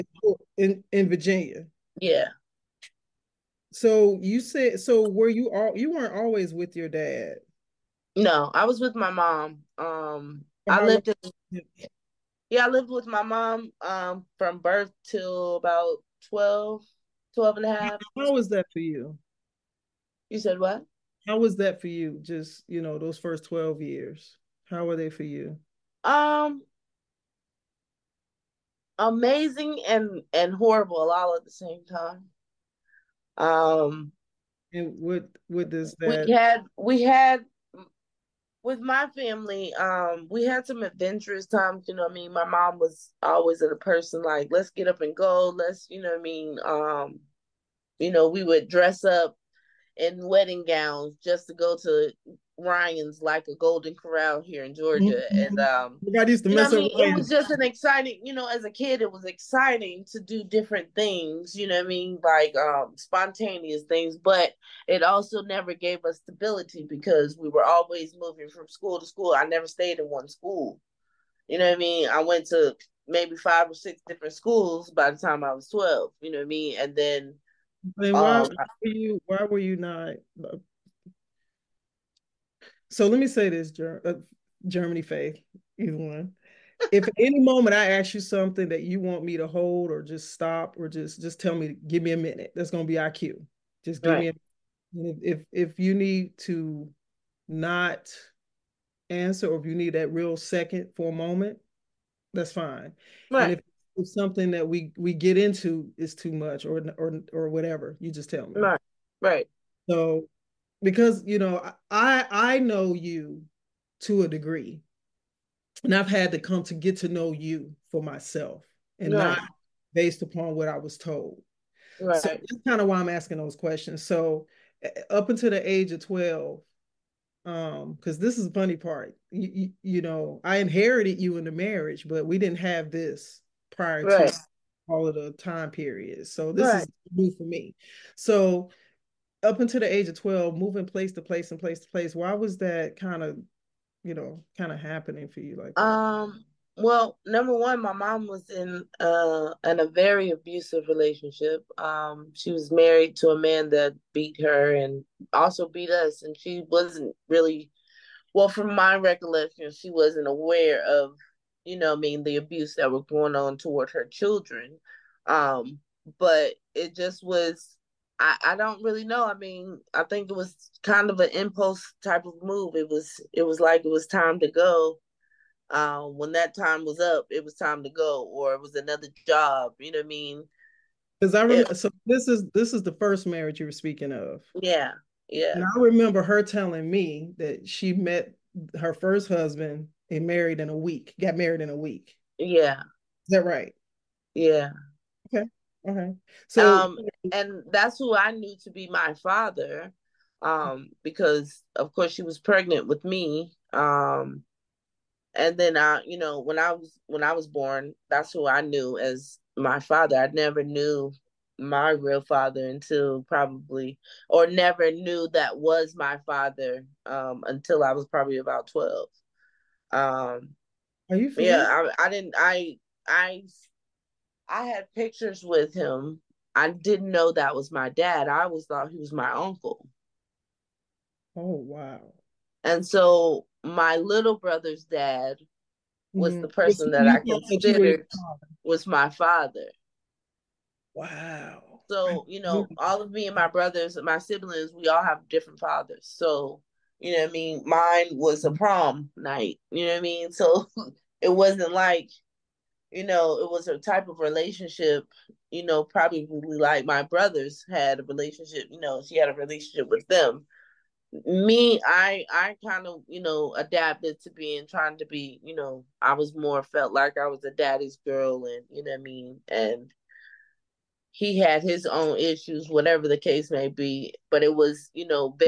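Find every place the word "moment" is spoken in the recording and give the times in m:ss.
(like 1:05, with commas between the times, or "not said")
1:27, 1:41.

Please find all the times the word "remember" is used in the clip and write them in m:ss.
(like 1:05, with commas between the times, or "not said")
3:01, 3:05.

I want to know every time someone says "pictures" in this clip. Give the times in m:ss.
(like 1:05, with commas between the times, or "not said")
3:44.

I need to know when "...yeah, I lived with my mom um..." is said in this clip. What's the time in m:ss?
0:12.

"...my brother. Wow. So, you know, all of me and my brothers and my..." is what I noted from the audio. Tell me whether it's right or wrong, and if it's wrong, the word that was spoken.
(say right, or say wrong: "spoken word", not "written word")
wrong: "father", not "brother".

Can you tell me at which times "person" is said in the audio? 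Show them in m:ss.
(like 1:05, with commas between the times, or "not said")
0:43, 3:56.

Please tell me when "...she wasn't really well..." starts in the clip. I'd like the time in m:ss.
2:36.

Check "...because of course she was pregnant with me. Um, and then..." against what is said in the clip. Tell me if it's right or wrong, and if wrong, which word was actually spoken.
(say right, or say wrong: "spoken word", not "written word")
right.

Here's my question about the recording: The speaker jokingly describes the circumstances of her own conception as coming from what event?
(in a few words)
Prom night.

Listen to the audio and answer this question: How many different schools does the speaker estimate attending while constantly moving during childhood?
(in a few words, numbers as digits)
5 or 6.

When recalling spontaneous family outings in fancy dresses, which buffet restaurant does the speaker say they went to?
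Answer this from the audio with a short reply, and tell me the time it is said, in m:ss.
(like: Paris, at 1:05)
Ryan's, at 0:52.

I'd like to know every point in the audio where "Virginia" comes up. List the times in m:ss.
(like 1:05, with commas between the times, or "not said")
0:01.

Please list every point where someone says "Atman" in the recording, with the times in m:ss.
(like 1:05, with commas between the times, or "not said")
not said.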